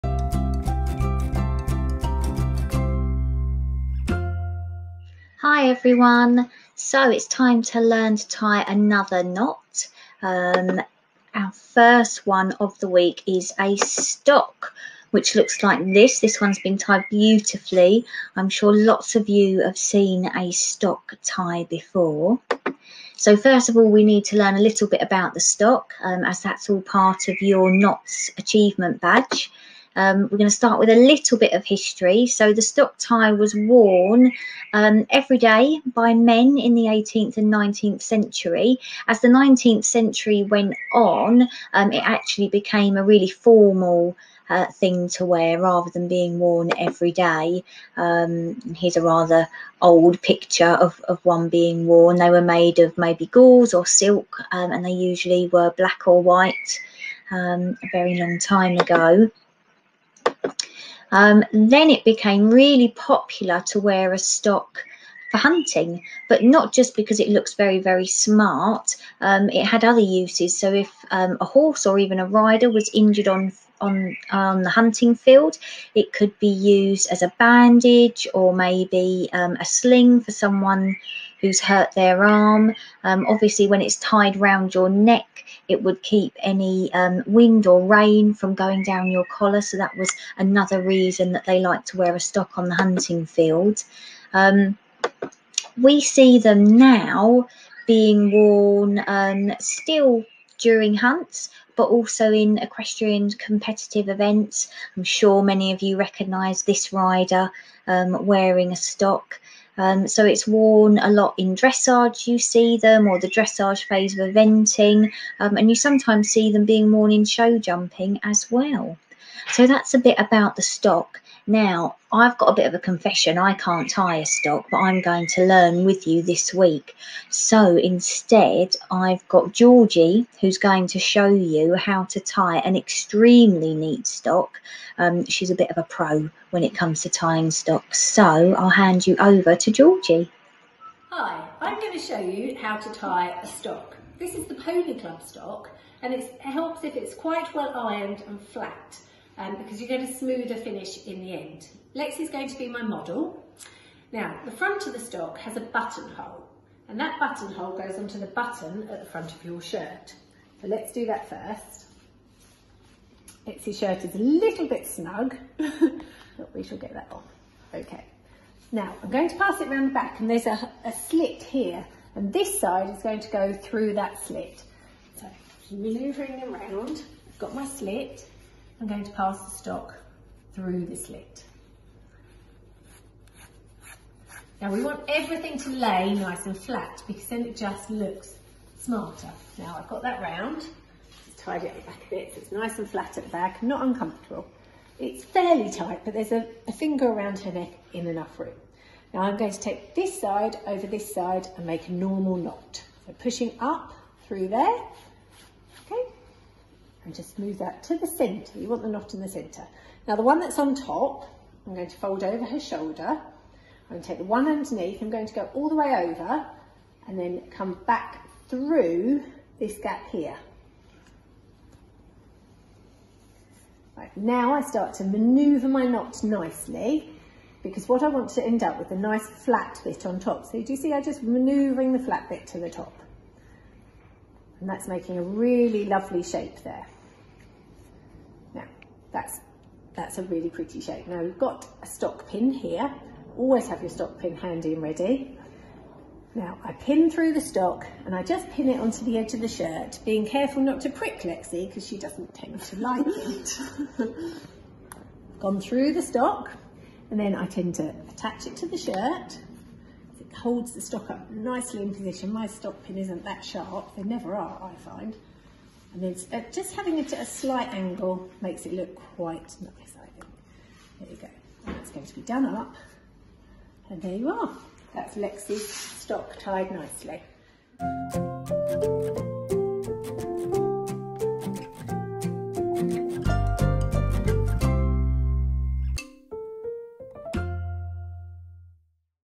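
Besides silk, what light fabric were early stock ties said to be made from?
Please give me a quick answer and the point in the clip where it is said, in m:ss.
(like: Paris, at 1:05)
gauze, at 0:53.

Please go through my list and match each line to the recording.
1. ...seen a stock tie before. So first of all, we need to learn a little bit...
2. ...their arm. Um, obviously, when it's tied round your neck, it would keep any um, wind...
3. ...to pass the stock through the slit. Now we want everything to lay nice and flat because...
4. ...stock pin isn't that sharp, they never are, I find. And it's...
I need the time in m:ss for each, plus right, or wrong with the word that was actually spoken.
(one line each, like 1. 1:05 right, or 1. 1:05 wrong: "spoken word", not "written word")
1. 0:19 right
2. 1:21 right
3. 2:59 right
4. 4:22 right.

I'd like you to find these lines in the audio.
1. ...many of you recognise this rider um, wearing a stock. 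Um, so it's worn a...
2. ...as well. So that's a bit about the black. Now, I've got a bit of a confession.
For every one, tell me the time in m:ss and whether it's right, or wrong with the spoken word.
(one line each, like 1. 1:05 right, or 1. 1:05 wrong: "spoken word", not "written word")
1. 1:45 right
2. 1:58 wrong: "stock", not "black".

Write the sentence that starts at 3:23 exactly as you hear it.
So pushing up through there, and just move that to the center.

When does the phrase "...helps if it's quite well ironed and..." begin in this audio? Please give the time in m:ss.
2:26.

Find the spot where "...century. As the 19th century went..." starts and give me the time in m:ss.
0:38.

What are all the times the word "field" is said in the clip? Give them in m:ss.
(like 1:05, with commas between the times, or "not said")
1:15, 1:33.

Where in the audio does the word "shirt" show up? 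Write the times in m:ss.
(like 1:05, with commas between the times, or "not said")
2:39, 2:43, 4:09, 4:18.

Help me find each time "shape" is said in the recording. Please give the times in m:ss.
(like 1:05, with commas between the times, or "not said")
3:56, 4:00.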